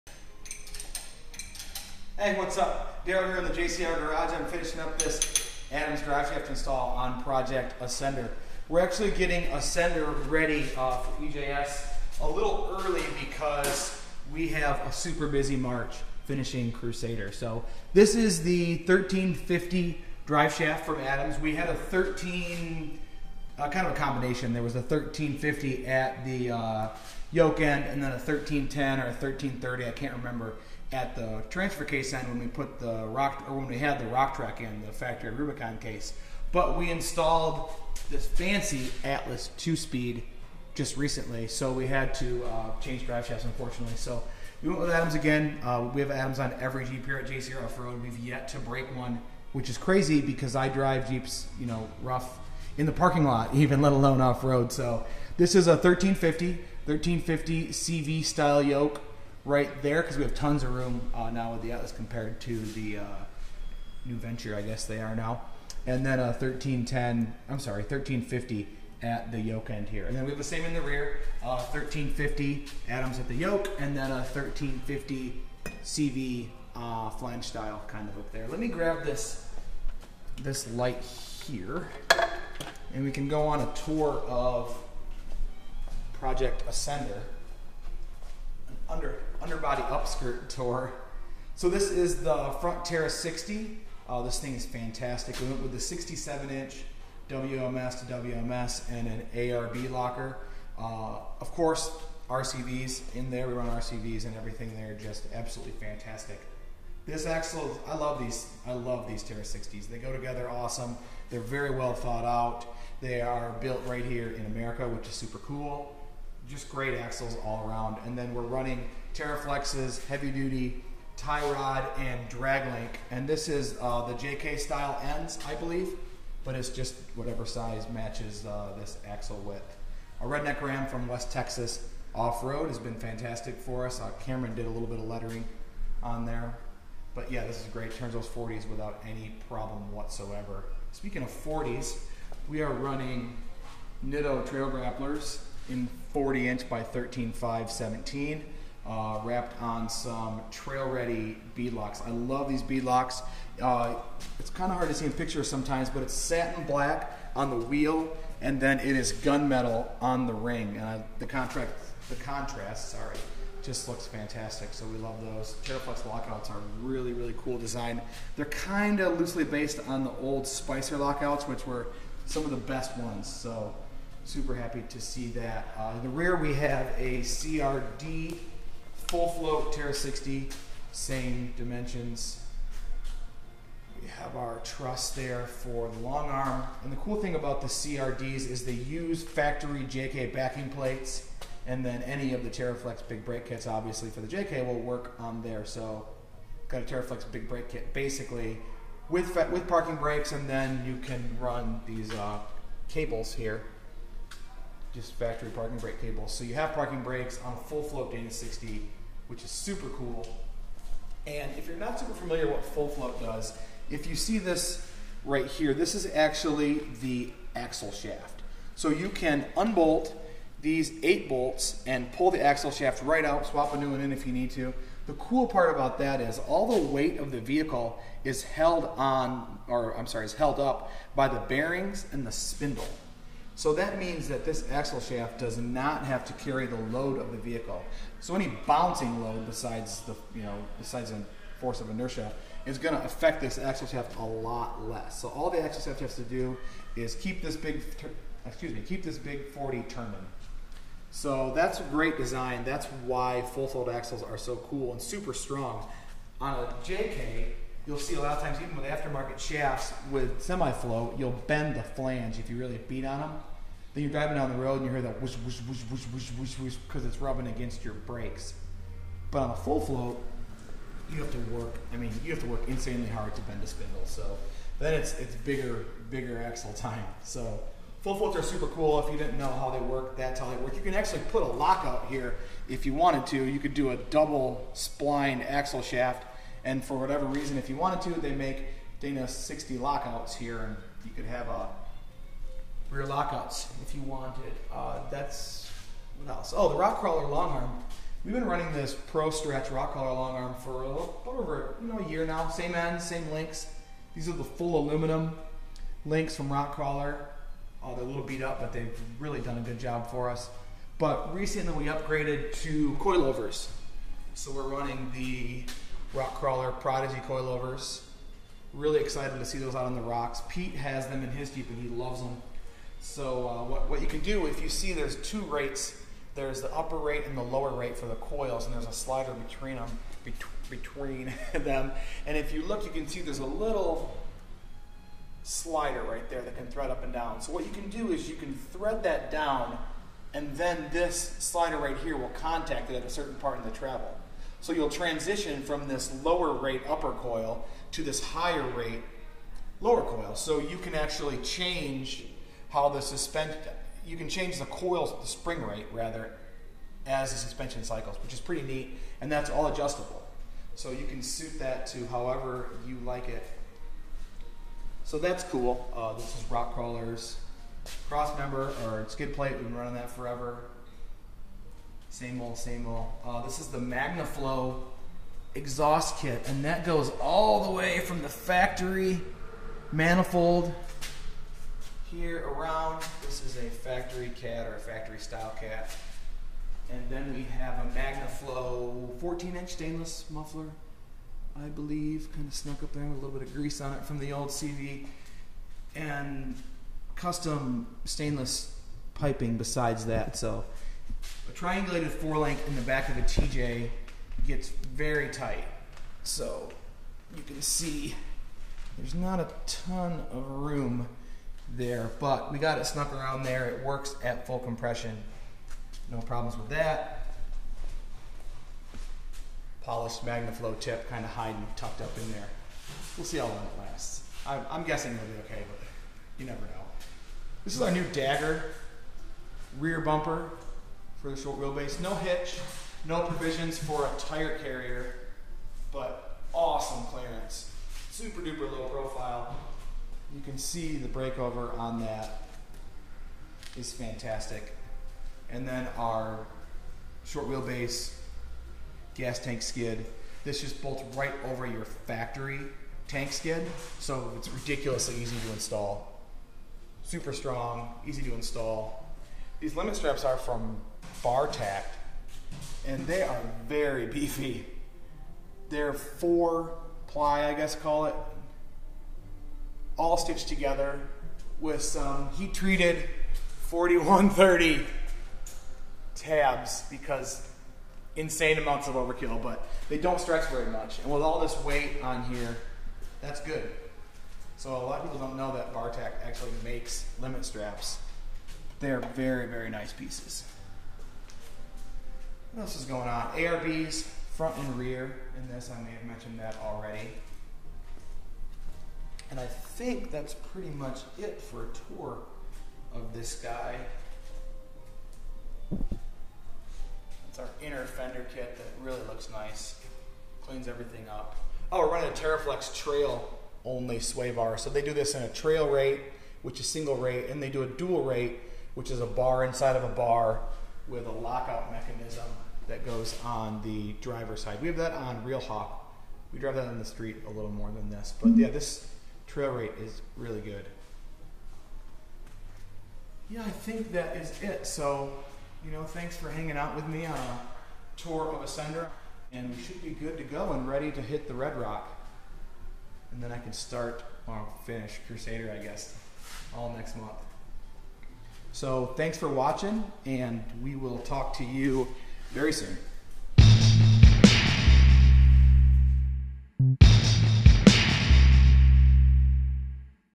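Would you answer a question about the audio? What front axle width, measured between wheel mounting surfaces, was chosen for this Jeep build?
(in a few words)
67 inch.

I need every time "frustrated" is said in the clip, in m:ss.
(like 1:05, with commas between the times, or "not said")
not said.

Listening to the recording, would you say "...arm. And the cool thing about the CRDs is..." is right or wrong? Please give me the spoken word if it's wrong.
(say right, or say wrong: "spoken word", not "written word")
right.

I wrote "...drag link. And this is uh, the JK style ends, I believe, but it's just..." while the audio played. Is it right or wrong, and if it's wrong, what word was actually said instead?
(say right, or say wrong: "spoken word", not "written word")
right.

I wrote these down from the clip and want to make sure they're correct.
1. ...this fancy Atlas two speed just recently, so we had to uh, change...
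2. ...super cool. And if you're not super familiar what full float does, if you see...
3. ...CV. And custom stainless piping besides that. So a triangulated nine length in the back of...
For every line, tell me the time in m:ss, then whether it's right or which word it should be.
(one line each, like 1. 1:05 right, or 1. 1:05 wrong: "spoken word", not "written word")
1. 0:38 right
2. 3:29 right
3. 6:34 wrong: "four", not "nine".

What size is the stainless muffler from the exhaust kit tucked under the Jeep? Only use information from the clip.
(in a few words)
14 inch.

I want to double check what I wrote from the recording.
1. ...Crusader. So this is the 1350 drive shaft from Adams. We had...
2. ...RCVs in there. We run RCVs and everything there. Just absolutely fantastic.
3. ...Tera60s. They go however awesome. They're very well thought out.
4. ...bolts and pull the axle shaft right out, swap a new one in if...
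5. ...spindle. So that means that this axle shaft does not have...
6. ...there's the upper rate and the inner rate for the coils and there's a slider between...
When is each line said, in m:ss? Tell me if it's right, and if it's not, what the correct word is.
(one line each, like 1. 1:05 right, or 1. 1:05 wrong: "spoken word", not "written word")
1. 0:16 right
2. 1:42 right
3. 1:49 wrong: "together", not "however"
4. 3:41 right
5. 3:52 right
6. 5:26 wrong: "lower", not "inner".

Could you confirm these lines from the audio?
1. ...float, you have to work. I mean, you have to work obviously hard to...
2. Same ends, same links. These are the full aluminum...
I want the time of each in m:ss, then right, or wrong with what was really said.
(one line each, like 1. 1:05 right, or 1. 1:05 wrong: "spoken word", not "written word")
1. 4:29 wrong: "insanely", not "obviously"
2. 5:02 right.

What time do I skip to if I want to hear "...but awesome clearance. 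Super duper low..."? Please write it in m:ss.
7:15.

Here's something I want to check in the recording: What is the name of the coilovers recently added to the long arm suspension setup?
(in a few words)
prodigy.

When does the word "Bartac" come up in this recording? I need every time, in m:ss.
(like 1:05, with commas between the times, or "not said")
7:41, 8:05.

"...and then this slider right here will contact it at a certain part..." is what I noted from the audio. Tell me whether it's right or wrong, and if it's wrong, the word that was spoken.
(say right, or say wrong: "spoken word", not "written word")
right.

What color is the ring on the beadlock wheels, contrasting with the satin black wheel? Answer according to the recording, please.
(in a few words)
gunmetal.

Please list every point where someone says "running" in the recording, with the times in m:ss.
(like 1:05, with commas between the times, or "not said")
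1:58, 2:22, 4:58, 5:14, 6:09, 8:31.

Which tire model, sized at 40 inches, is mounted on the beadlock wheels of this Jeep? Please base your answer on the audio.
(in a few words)
Nitto Trail Grapplers.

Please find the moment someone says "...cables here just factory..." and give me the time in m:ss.
3:22.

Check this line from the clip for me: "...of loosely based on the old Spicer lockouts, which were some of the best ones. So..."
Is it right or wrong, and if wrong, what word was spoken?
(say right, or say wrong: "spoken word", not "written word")
right.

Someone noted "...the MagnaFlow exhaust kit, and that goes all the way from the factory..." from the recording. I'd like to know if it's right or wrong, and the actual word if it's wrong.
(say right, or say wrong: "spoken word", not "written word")
right.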